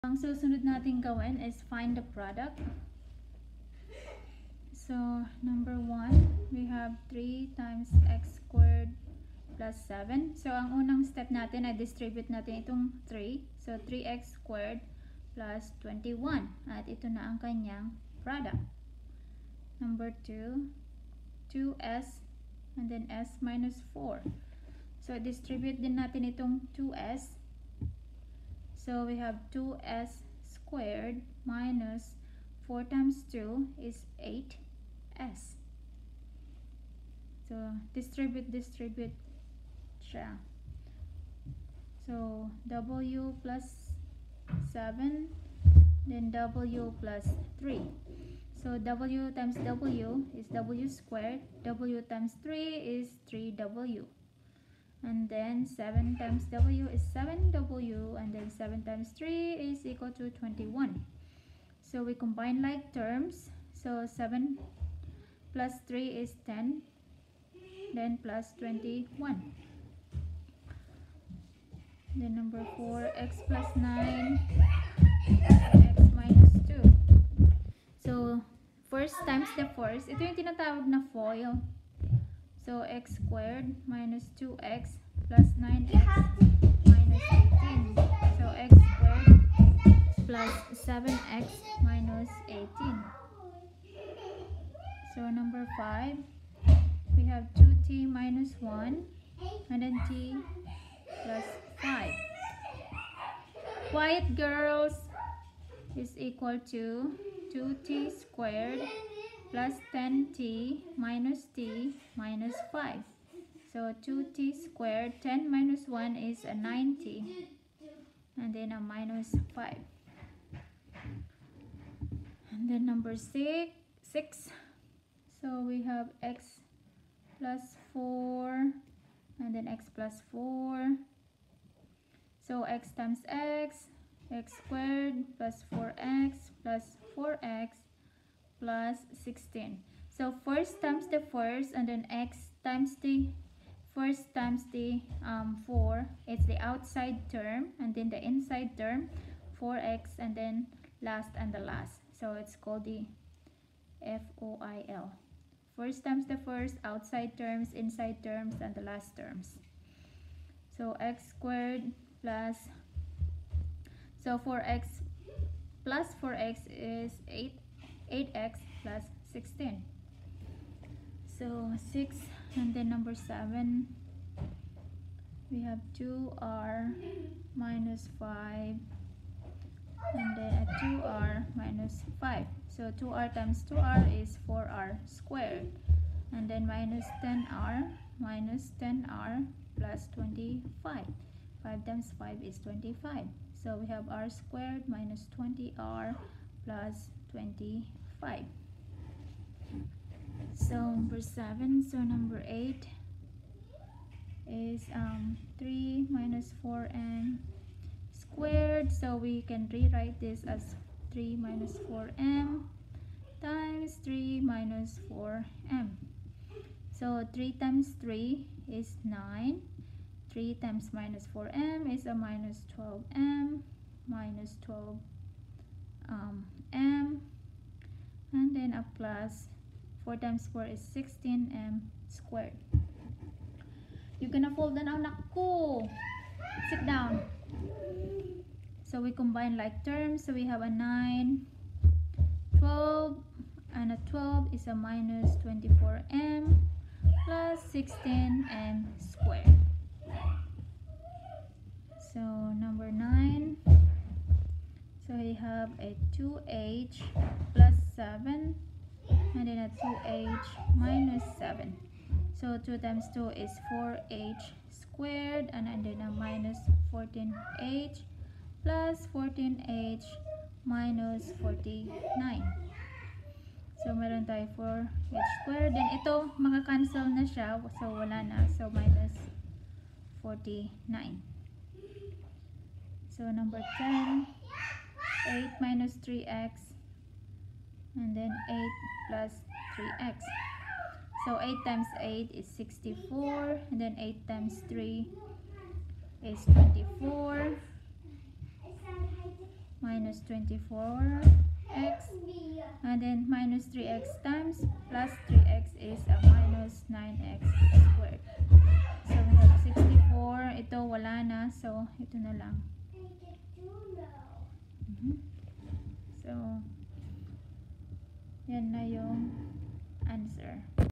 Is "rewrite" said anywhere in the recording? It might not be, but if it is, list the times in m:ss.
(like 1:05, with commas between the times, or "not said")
3:29.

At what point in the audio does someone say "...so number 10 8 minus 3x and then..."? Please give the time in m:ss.
4:43.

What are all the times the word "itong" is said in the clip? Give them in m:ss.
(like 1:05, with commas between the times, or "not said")
0:12, 0:26.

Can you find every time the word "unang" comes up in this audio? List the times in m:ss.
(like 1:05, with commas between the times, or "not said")
0:10.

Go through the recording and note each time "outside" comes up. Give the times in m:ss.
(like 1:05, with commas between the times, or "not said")
2:26, 2:36.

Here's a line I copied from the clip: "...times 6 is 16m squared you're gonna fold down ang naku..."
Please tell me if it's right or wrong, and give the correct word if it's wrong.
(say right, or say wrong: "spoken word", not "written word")
wrong: "4", not "6".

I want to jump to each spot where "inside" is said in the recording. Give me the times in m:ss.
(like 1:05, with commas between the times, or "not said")
2:28, 2:37.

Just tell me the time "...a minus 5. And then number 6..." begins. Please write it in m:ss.
1:58.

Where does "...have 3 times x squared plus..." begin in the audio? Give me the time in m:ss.
0:06.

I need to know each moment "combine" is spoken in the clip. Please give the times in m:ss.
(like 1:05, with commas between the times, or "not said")
1:02, 3:59.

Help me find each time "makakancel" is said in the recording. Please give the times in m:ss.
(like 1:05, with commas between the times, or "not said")
4:36.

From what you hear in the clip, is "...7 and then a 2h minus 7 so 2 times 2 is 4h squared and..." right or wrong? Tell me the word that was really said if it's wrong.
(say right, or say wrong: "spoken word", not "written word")
right.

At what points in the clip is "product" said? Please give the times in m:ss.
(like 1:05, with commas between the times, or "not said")
0:02, 0:18.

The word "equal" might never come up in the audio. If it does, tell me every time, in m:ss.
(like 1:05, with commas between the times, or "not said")
0:59, 1:46.